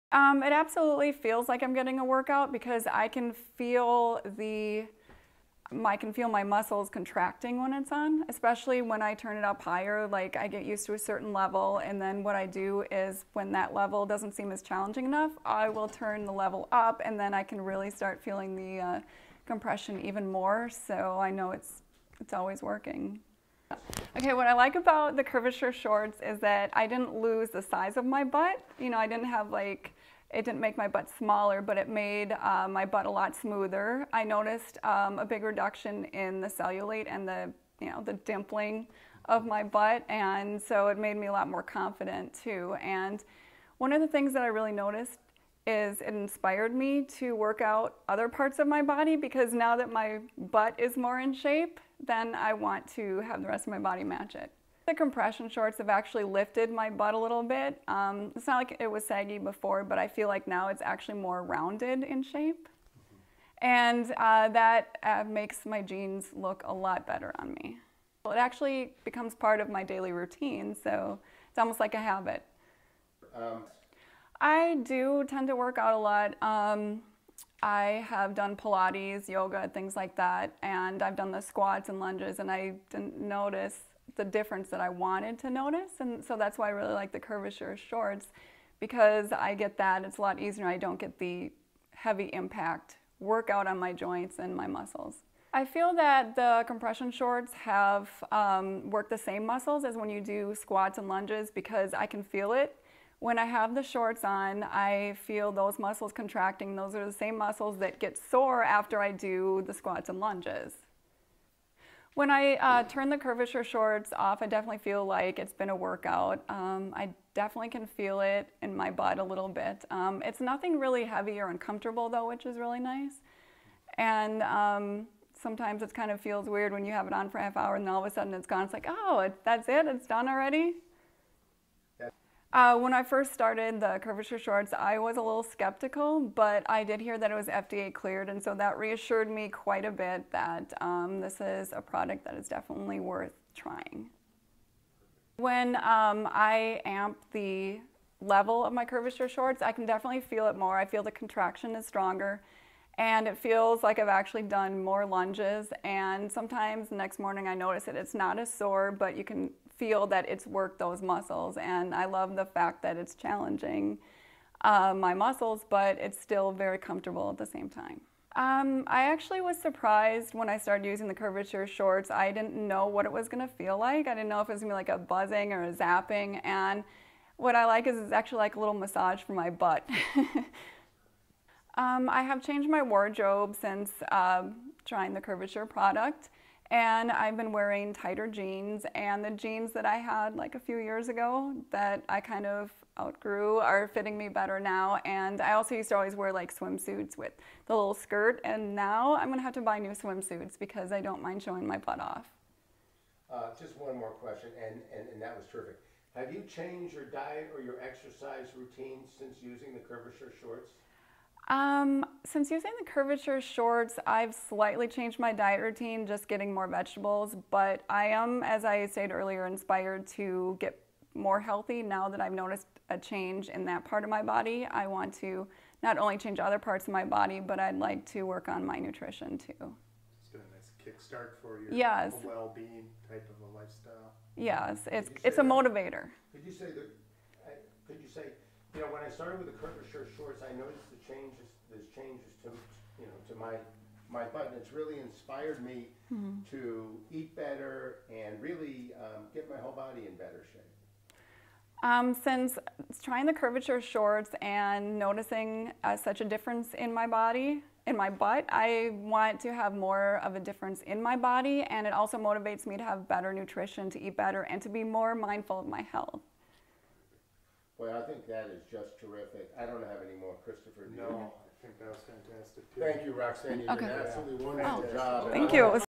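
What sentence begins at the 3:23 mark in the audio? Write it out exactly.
Uh, just one more question and, and, and that was terrific.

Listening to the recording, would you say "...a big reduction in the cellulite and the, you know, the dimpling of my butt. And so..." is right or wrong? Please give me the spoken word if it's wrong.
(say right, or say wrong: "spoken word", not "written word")
right.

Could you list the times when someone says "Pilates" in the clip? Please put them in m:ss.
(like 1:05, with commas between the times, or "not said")
1:18.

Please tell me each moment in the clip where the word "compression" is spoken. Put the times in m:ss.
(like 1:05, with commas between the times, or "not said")
0:19, 0:54, 1:36.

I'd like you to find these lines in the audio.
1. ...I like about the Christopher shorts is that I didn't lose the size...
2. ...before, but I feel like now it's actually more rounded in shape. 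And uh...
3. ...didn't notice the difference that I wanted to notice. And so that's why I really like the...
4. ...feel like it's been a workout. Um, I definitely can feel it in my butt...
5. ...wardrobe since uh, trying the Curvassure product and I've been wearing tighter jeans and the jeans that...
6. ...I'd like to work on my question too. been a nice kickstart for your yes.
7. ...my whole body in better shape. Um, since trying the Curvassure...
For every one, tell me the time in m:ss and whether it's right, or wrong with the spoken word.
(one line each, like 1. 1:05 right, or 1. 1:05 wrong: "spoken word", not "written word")
1. 0:24 wrong: "Curvassure", not "Christopher"
2. 0:59 right
3. 1:22 right
4. 1:54 right
5. 3:02 right
6. 3:47 wrong: "nutrition", not "question"
7. 4:09 right.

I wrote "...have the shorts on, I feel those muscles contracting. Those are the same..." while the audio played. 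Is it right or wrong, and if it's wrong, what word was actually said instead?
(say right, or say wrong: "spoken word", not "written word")
right.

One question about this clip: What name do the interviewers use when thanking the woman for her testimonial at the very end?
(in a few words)
Roxanne.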